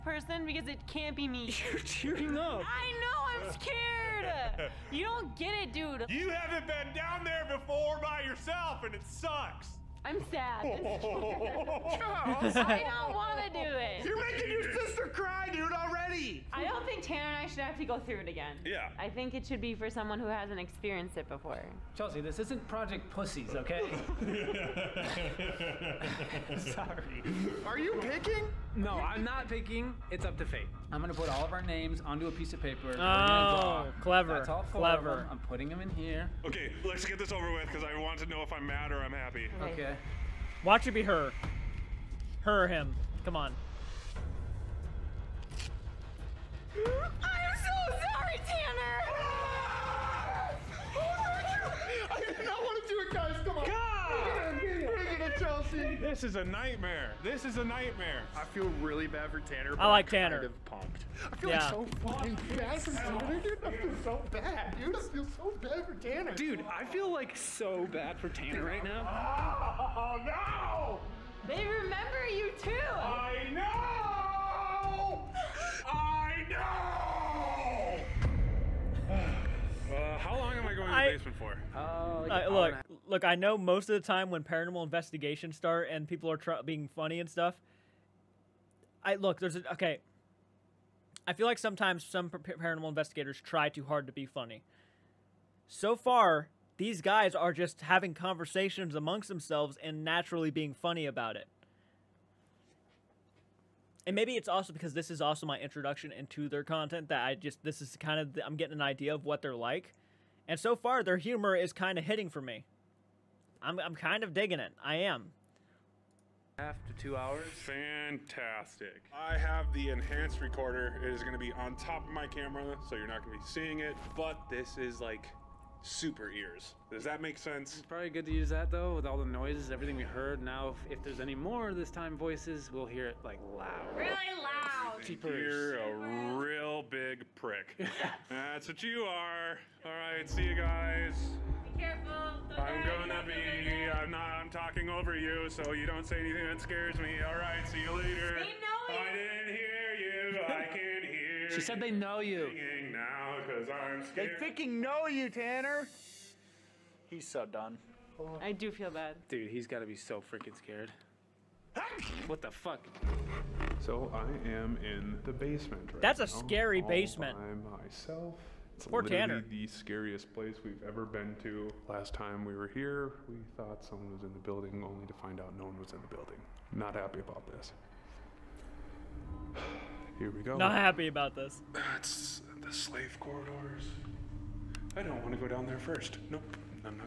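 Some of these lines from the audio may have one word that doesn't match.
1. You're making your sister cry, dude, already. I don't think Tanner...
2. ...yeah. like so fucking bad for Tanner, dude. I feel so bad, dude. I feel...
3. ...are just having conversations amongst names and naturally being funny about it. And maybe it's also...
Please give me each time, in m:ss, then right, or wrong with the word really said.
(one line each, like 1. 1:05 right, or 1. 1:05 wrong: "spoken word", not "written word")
1. 0:14 right
2. 1:01 right
3. 1:37 wrong: "themselves", not "names".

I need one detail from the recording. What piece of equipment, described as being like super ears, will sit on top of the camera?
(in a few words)
enhanced recorder.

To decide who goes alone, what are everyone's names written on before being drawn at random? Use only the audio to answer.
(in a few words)
a piece of paper.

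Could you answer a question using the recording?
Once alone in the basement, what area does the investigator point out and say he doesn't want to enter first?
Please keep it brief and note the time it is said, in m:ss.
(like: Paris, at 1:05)
the slave corridors, at 3:02.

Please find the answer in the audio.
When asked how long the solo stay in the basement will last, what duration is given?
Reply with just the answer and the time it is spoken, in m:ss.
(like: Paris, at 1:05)
2 hours, at 1:56.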